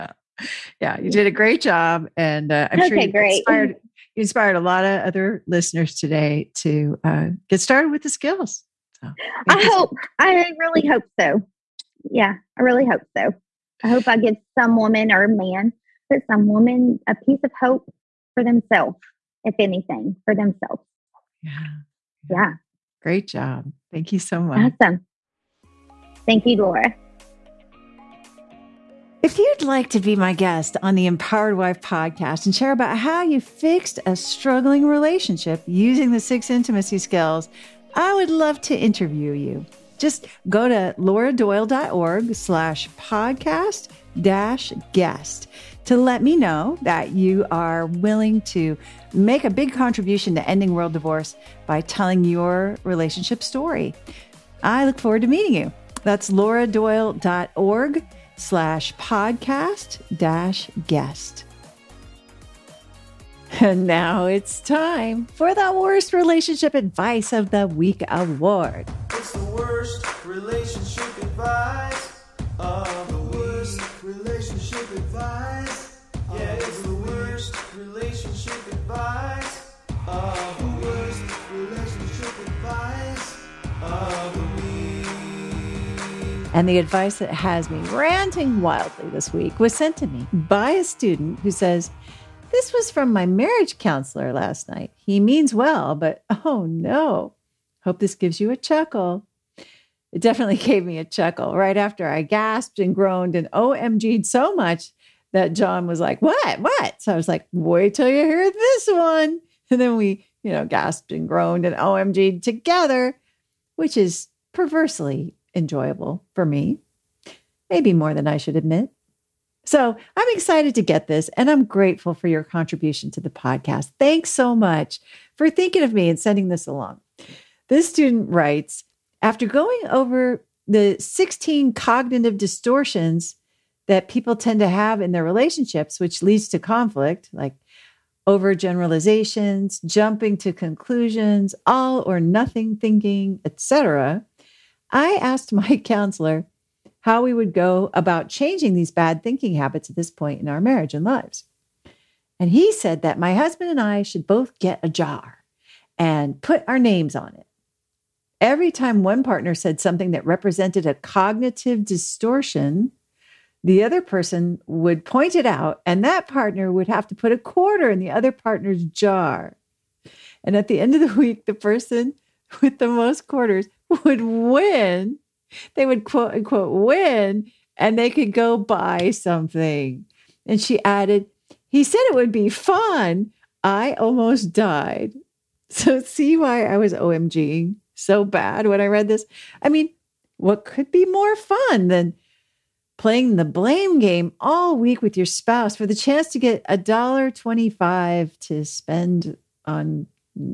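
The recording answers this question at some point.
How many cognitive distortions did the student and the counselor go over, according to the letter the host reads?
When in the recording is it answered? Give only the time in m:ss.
2:10.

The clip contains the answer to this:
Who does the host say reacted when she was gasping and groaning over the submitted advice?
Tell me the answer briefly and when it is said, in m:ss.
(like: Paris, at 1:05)
John, at 1:45.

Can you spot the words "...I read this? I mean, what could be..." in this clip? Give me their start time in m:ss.
3:08.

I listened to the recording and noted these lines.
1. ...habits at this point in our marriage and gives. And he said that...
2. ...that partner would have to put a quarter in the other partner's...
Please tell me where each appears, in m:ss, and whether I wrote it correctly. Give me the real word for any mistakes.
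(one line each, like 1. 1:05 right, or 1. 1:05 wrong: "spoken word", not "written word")
1. 2:29 wrong: "lives", not "gives"
2. 2:46 right.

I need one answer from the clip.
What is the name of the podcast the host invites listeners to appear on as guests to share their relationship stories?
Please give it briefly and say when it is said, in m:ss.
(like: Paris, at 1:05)
Empowered Wife, at 0:31.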